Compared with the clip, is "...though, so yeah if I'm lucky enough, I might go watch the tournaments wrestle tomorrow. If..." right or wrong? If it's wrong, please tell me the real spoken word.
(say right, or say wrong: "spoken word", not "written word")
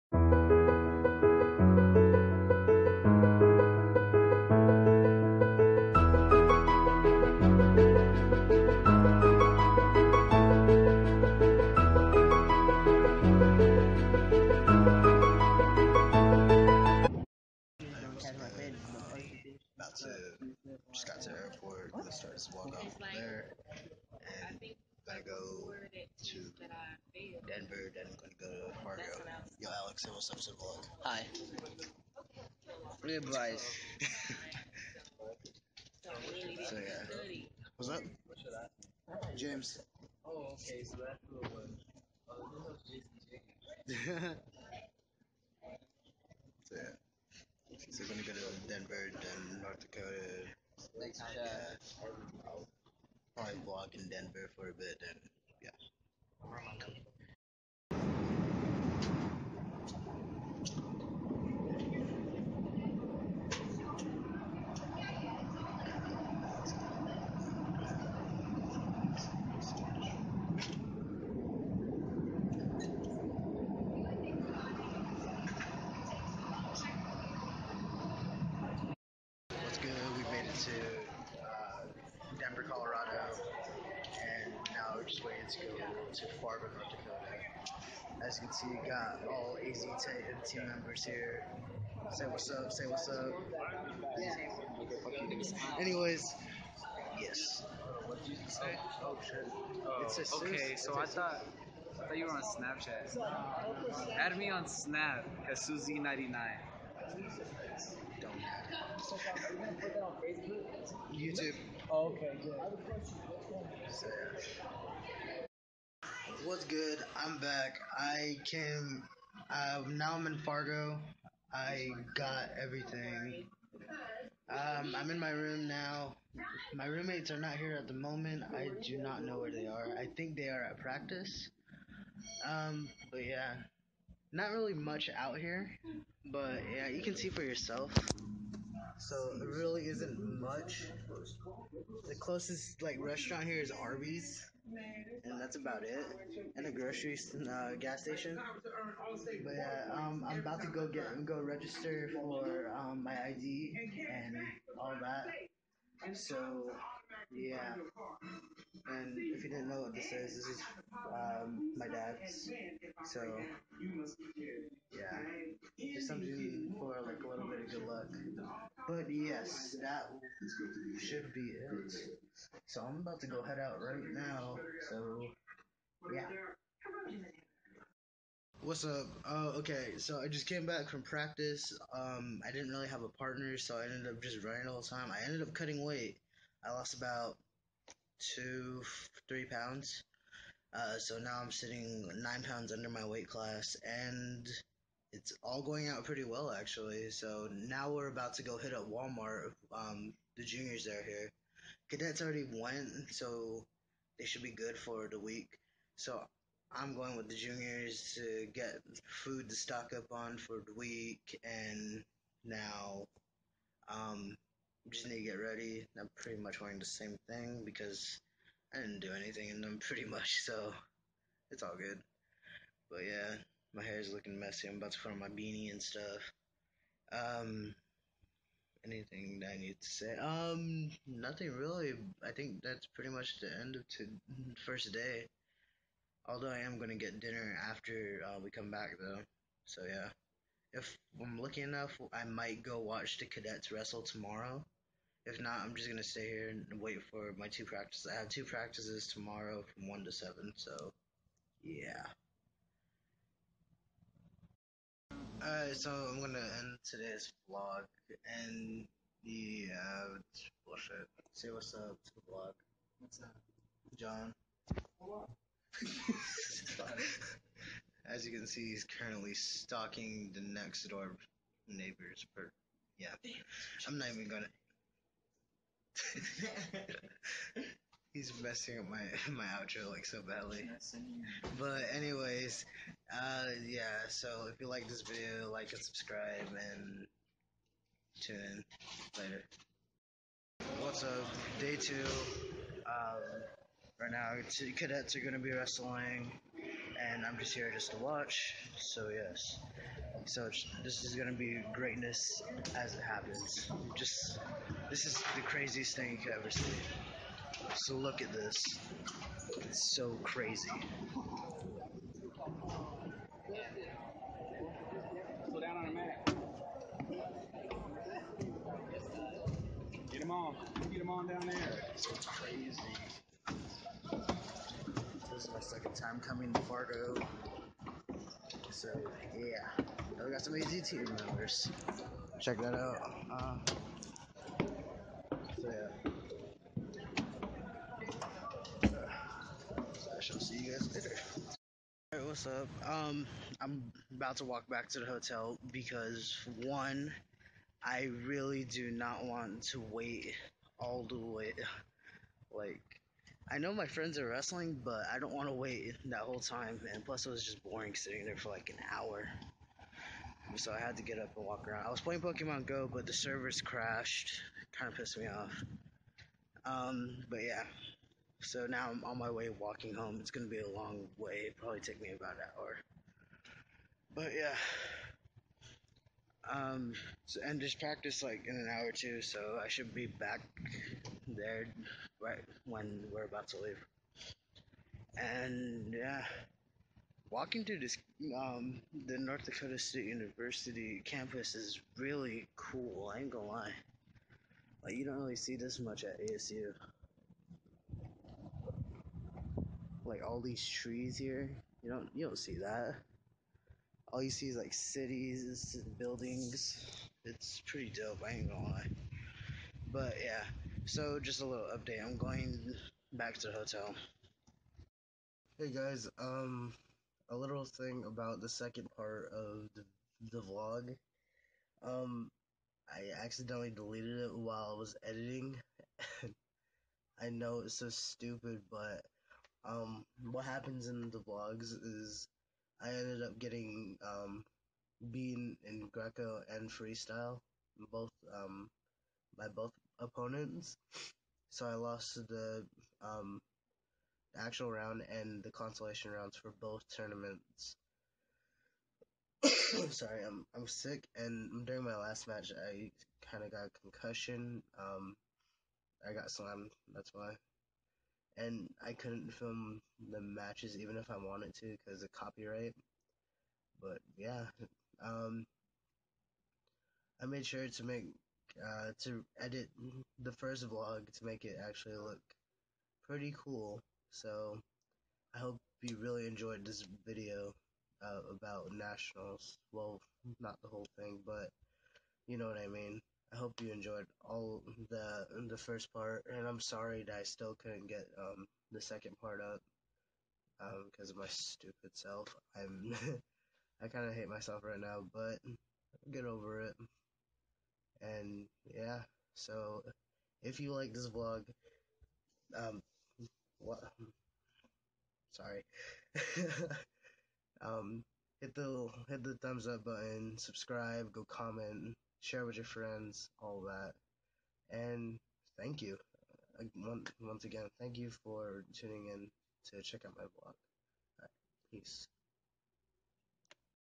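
wrong: "cadets", not "tournaments".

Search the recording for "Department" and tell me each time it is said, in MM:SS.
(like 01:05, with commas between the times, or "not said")
01:26.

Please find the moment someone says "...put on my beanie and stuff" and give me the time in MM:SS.
03:44.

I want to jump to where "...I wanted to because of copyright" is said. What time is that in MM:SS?
07:41.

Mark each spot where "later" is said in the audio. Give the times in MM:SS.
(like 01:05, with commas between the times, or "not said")
04:49, 05:40.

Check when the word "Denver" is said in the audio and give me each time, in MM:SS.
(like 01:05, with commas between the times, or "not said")
00:27, 00:48, 00:54.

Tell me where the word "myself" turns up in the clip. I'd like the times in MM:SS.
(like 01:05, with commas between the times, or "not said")
08:14.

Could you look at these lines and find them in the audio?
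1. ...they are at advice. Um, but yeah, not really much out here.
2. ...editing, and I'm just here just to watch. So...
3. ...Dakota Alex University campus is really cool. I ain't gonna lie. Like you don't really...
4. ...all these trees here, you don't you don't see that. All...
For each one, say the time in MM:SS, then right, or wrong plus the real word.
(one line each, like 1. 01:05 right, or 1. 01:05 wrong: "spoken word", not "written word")
1. 02:10 wrong: "practice", not "advice"
2. 04:55 wrong: "wrestling", not "editing"
3. 06:29 wrong: "State", not "Alex"
4. 06:40 right.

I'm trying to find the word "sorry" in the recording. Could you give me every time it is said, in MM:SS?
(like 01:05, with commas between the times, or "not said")
07:29, 08:06, 08:25.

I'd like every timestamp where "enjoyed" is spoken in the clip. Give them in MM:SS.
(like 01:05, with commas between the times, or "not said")
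07:56, 08:03.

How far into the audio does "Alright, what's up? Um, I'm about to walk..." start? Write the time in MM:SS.
05:42.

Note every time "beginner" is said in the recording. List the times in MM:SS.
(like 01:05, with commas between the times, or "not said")
not said.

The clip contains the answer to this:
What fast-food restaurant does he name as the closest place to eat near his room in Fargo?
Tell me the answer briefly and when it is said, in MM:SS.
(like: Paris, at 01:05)
Arby's, at 02:23.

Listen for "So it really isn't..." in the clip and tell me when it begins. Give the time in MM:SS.
02:18.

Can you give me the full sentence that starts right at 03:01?
Um, I didn't really have a partner, so I ended up just running all the time.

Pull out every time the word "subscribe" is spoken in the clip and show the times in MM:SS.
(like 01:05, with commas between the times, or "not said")
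04:45, 08:30.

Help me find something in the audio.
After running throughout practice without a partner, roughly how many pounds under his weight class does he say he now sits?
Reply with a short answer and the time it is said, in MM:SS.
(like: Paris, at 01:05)
9, at 03:12.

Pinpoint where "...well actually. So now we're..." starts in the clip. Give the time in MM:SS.
03:16.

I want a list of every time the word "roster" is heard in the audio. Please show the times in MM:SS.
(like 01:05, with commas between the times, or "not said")
not said.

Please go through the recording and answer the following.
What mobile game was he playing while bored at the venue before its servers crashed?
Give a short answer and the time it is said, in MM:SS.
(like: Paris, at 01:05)
Pokemon Go, at 06:02.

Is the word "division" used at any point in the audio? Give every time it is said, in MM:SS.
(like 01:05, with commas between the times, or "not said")
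not said.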